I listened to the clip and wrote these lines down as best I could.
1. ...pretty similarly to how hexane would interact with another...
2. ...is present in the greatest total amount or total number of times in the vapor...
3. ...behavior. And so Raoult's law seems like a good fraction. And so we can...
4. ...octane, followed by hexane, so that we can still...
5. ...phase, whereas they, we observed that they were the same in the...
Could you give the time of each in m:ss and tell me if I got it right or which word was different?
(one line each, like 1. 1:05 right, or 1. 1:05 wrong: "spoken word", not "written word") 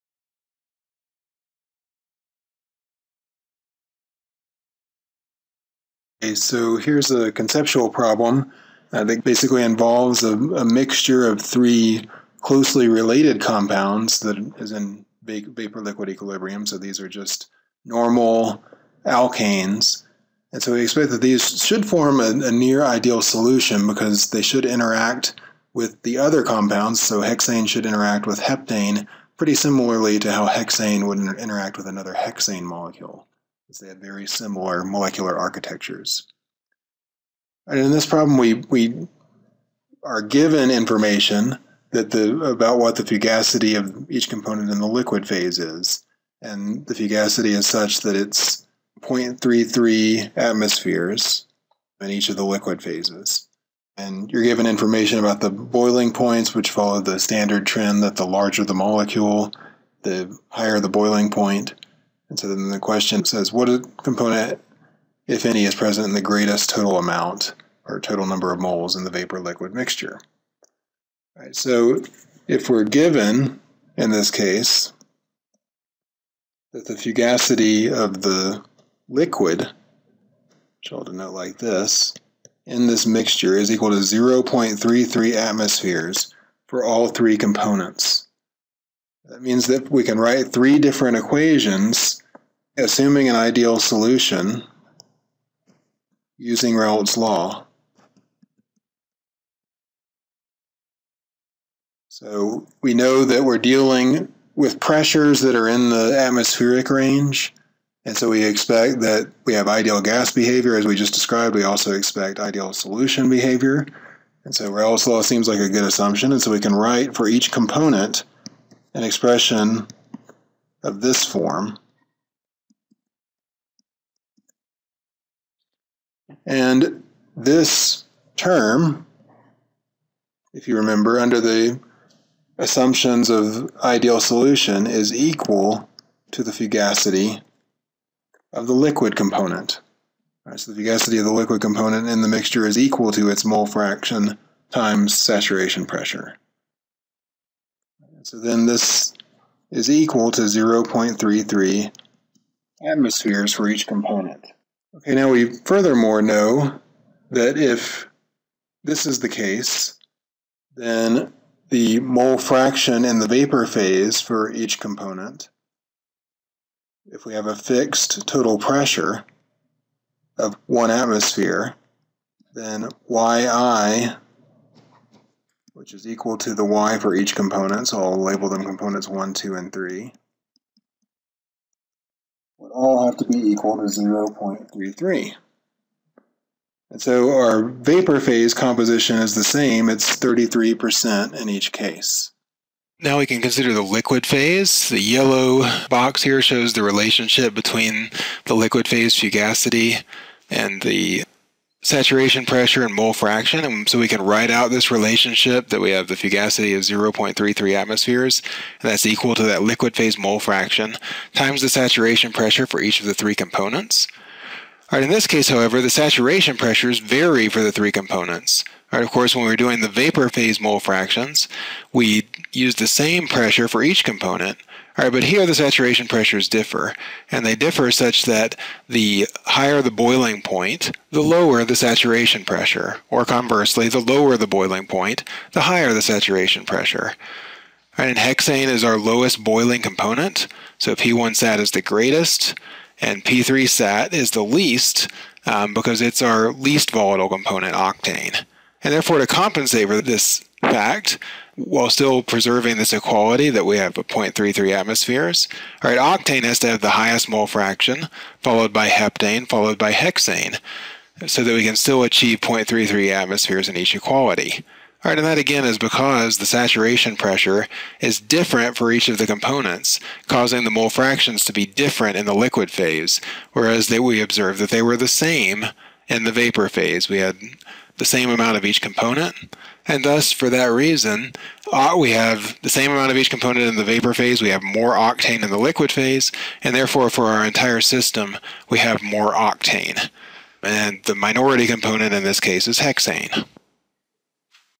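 1. 0:29 right
2. 1:05 wrong: "moles", not "times"
3. 1:53 wrong: "assumption", not "fraction"
4. 4:18 wrong: "heptane", not "octane"
5. 4:32 right.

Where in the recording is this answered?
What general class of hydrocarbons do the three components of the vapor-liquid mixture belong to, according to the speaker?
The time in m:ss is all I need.
0:17.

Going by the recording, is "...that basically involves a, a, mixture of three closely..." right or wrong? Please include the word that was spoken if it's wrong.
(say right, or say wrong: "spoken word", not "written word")
right.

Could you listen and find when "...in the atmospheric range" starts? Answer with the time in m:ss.
1:45.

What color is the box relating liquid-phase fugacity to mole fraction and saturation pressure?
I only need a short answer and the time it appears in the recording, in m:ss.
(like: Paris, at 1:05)
yellow, at 3:15.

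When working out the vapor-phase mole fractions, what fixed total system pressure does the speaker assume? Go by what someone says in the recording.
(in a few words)
1 atmosphere.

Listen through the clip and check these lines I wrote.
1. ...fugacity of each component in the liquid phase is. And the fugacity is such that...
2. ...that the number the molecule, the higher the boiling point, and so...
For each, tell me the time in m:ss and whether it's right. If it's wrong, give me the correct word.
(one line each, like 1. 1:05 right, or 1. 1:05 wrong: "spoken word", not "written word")
1. 0:43 right
2. 0:58 wrong: "larger", not "number".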